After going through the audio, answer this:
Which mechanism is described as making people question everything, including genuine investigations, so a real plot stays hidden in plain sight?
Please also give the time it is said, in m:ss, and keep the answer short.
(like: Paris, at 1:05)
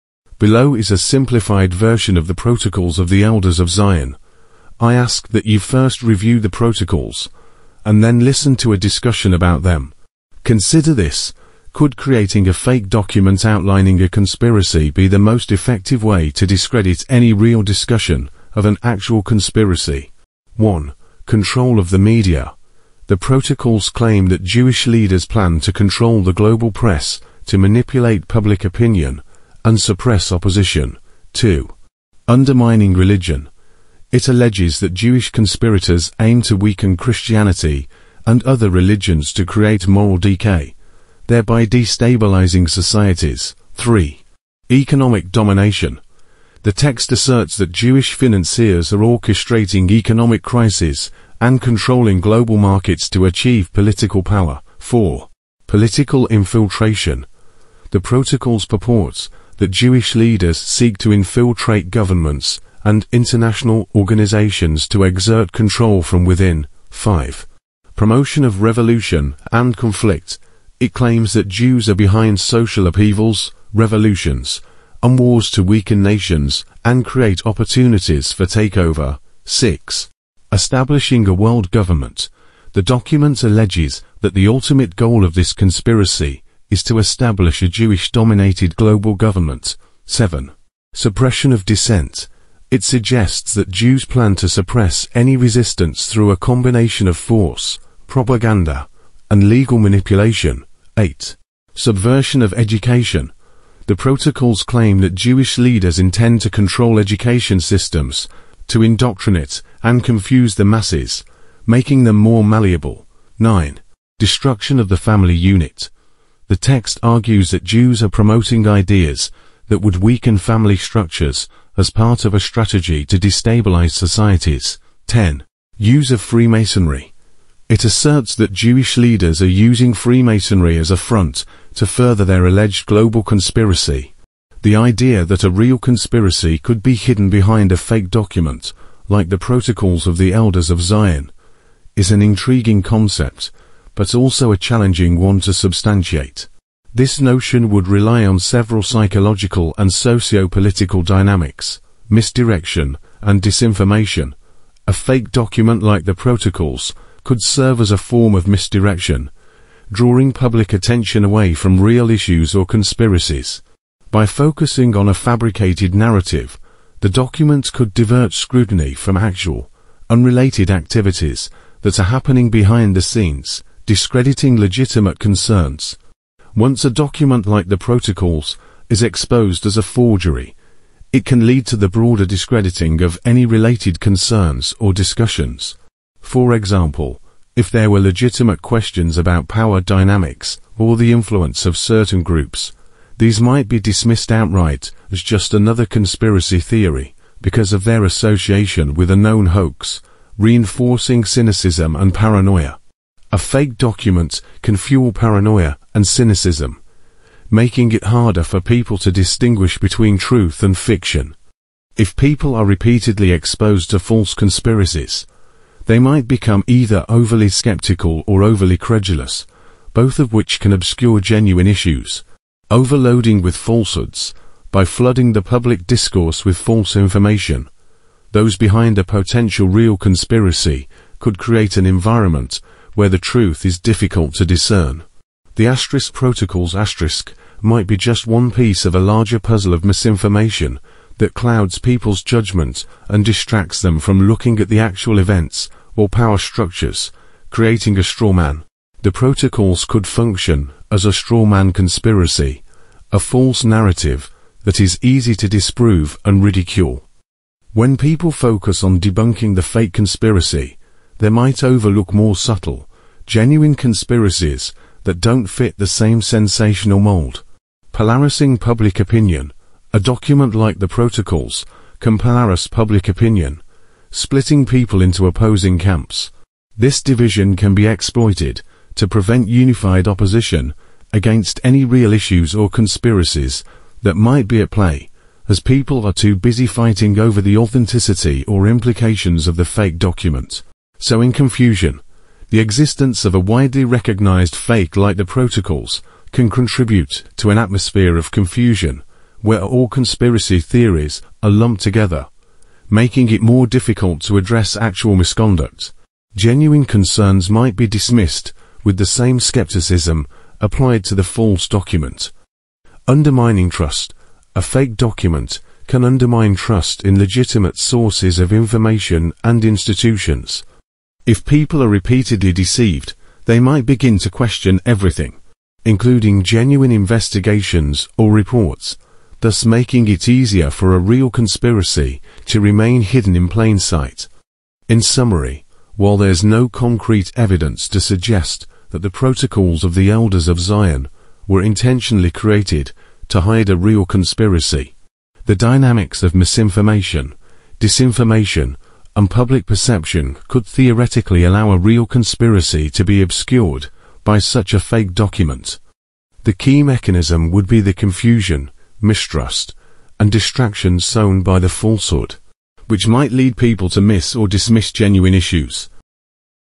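Undermining trust, at 5:13.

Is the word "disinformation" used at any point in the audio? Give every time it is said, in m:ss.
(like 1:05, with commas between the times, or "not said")
2:33, 5:47.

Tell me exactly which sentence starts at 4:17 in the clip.
When people focus on debunking the fake conspiracy, they might overlook more subtle, genuine conspiracies that don't fit the same sensational mold.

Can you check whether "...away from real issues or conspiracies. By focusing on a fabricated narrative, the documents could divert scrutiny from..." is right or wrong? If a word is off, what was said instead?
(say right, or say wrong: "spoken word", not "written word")
right.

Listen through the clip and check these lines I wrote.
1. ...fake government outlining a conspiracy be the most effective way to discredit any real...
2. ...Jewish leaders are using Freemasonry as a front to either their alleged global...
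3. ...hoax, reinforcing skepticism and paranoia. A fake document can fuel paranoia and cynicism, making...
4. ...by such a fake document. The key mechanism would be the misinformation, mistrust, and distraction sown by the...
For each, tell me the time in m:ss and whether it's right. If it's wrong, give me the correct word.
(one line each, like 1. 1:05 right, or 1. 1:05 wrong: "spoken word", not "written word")
1. 0:12 wrong: "document", not "government"
2. 2:08 wrong: "further", not "either"
3. 3:19 wrong: "cynicism", not "skepticism"
4. 5:54 wrong: "confusion", not "misinformation".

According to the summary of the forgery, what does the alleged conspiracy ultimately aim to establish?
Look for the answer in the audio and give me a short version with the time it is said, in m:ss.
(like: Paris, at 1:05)
A world government, at 1:21.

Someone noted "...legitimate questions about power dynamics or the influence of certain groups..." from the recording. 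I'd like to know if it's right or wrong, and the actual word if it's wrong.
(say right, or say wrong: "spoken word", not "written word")
right.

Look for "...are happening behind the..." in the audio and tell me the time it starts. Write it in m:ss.
2:51.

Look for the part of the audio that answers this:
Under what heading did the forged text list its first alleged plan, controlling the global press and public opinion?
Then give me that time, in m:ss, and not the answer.
0:21.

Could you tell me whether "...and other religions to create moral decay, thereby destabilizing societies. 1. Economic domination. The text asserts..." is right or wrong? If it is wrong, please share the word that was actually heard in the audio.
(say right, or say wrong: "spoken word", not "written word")
wrong: "3", not "1".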